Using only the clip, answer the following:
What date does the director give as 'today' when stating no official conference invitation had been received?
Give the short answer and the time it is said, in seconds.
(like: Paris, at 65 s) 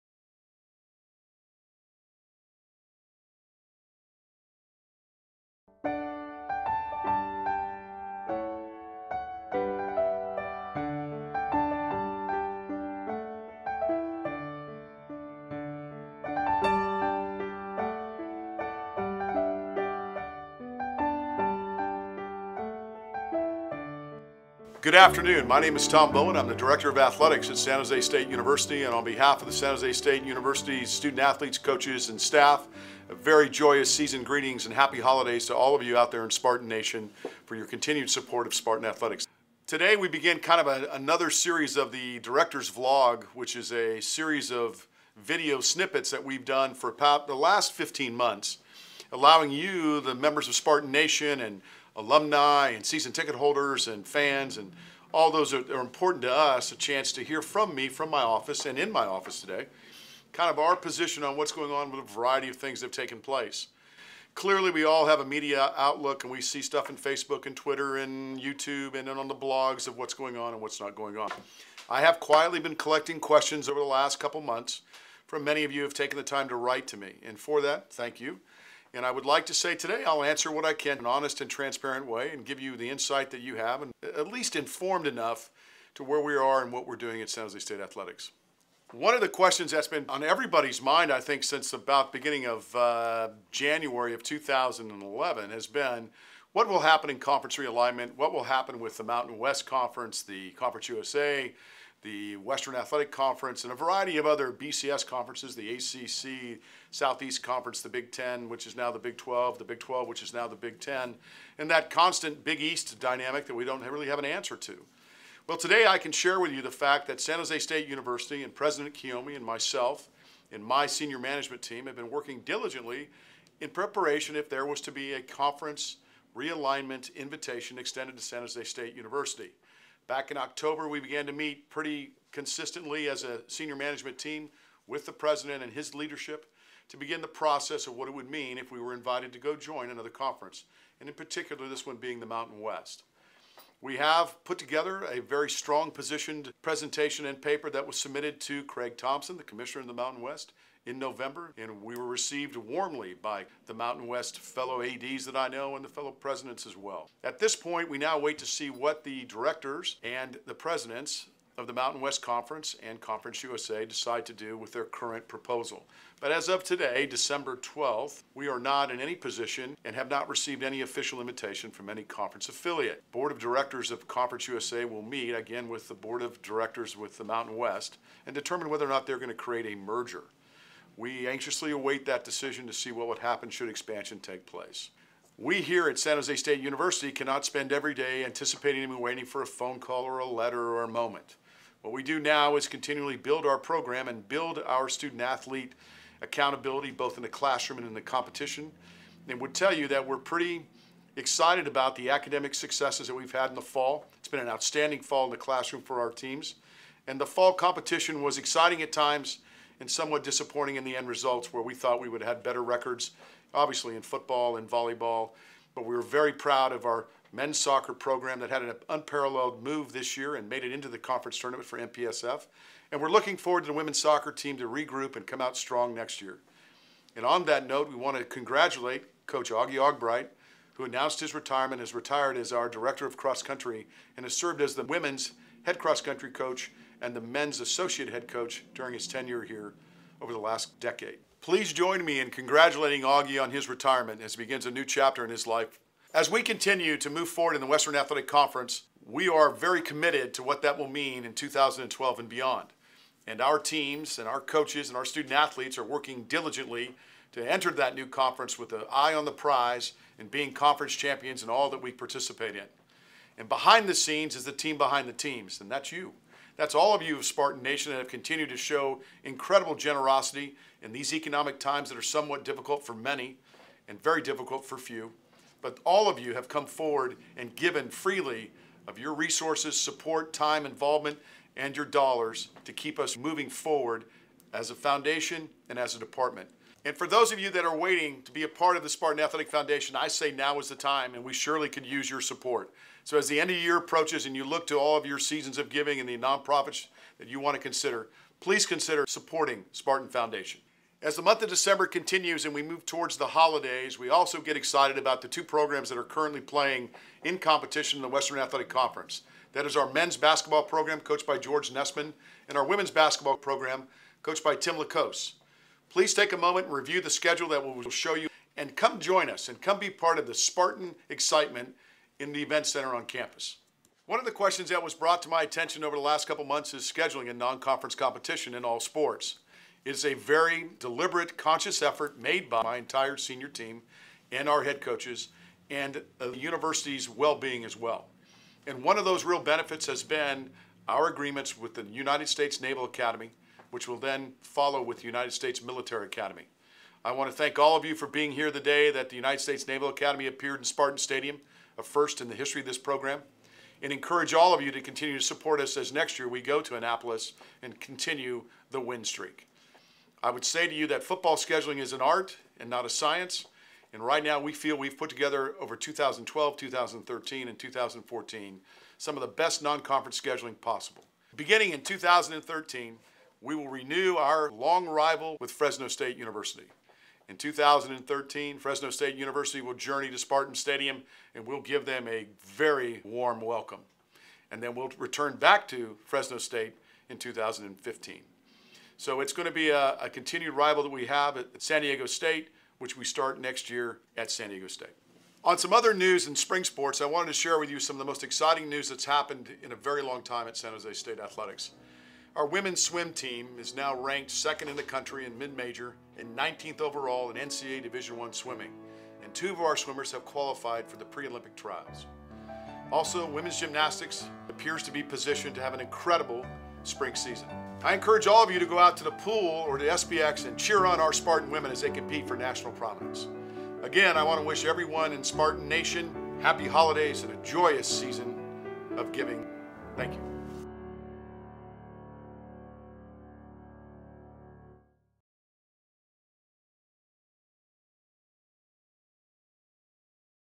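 December 12th, at 167 s.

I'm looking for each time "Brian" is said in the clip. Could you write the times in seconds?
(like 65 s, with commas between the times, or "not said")
not said.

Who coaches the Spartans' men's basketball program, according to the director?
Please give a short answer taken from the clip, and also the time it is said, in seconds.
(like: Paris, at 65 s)
George Nessman, at 311 s.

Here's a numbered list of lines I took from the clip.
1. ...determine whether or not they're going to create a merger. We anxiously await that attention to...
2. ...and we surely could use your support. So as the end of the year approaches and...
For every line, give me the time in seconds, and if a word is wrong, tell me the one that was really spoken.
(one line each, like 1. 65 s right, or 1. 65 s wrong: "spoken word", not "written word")
1. 178 s wrong: "decision", not "attention"
2. 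291 s right.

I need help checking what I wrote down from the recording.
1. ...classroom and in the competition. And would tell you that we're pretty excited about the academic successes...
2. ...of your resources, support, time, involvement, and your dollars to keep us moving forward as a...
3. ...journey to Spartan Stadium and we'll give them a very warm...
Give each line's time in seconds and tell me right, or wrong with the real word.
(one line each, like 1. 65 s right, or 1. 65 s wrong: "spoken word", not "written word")
1. 197 s right
2. 278 s right
3. 379 s right.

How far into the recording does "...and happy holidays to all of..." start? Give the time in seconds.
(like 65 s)
34 s.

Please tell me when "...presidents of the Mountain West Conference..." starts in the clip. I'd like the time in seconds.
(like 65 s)
160 s.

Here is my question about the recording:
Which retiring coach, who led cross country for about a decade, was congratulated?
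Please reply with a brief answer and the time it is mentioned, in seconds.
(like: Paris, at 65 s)
Augie Argabright, at 229 s.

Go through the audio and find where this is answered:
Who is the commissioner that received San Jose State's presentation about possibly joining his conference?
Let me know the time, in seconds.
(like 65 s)
148 s.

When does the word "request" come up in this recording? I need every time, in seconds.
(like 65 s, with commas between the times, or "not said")
not said.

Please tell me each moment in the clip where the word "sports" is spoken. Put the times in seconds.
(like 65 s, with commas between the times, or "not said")
328 s, 396 s.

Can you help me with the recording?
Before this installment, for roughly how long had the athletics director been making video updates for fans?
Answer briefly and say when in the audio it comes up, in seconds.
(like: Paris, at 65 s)
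15 months, at 47 s.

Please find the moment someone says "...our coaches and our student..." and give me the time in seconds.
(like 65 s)
254 s.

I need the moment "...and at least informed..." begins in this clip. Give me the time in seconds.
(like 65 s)
83 s.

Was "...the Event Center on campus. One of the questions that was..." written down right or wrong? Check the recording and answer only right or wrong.
right.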